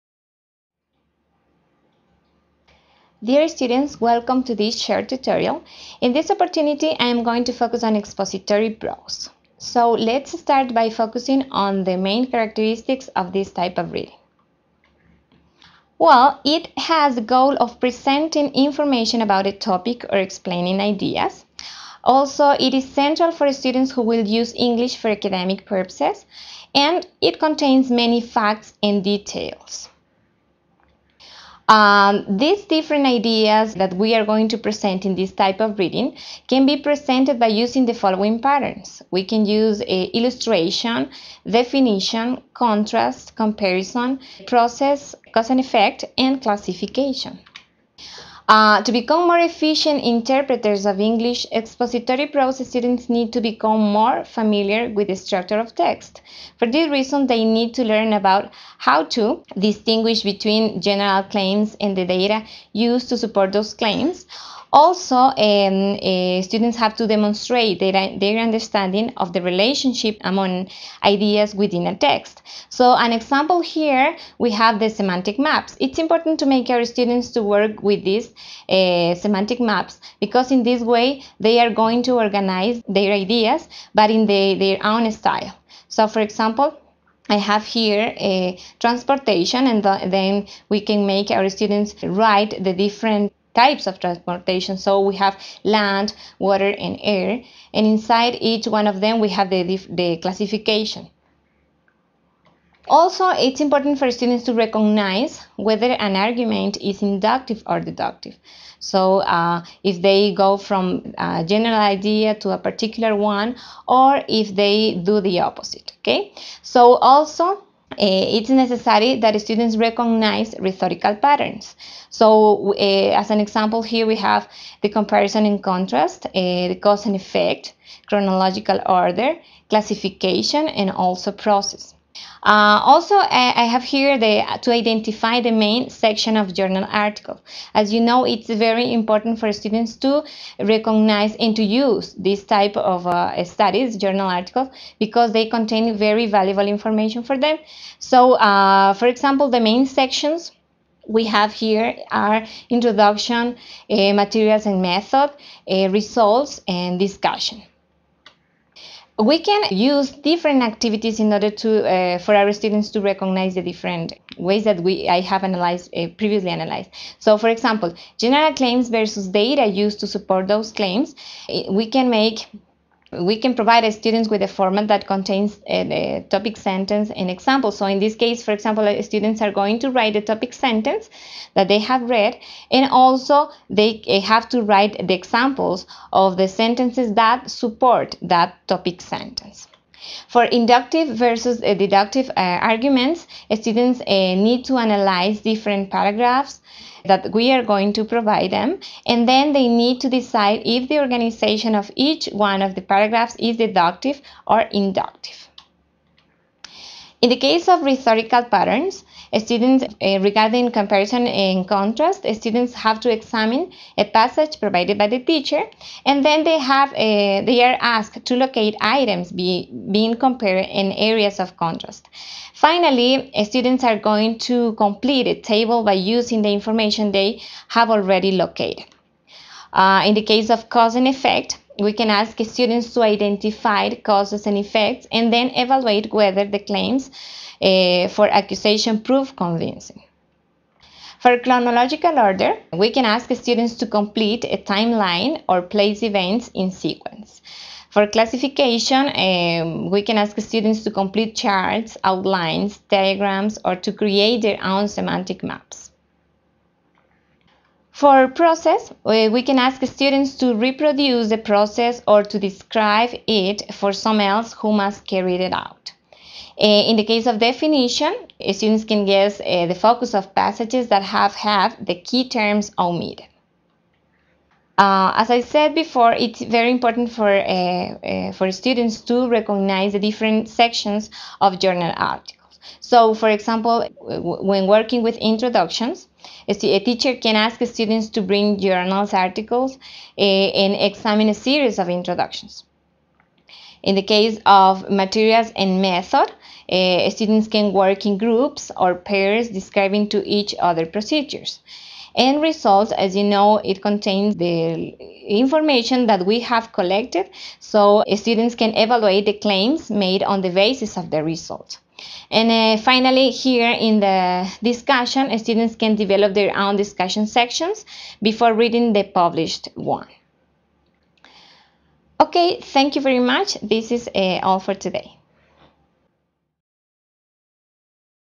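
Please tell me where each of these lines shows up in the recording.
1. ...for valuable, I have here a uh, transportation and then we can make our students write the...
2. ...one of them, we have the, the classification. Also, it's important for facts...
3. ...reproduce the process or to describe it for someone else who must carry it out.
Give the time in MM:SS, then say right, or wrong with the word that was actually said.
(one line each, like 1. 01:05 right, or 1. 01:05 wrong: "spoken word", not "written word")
1. 01:26 wrong: "example", not "valuable"
2. 01:38 wrong: "students", not "facts"
3. 04:20 right.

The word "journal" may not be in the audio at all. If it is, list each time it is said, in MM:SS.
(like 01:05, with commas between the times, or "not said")
02:16, 02:23, 04:41, 04:48.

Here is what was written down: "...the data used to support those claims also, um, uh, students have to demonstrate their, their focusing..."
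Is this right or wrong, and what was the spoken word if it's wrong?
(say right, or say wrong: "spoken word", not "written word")
wrong: "understanding", not "focusing".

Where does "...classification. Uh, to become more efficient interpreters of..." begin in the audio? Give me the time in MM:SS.
00:46.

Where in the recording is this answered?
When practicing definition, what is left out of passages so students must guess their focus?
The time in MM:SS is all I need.
04:31.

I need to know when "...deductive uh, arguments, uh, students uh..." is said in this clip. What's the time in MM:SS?
03:11.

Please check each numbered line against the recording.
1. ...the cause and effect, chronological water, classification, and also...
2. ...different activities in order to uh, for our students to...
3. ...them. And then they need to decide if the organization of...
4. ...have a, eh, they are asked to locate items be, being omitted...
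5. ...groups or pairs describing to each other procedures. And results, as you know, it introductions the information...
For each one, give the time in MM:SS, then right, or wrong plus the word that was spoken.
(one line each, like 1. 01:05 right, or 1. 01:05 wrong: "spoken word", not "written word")
1. 02:06 wrong: "order", not "water"
2. 02:40 right
3. 03:18 right
4. 03:36 wrong: "compared", not "omitted"
5. 04:58 wrong: "contains", not "introductions".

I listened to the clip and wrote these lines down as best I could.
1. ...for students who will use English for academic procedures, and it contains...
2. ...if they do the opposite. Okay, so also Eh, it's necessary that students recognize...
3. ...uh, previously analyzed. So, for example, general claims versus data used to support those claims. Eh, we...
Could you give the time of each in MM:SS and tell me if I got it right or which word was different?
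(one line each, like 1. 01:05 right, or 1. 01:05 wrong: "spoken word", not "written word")
1. 00:23 wrong: "purposes", not "procedures"
2. 01:54 right
3. 02:45 right.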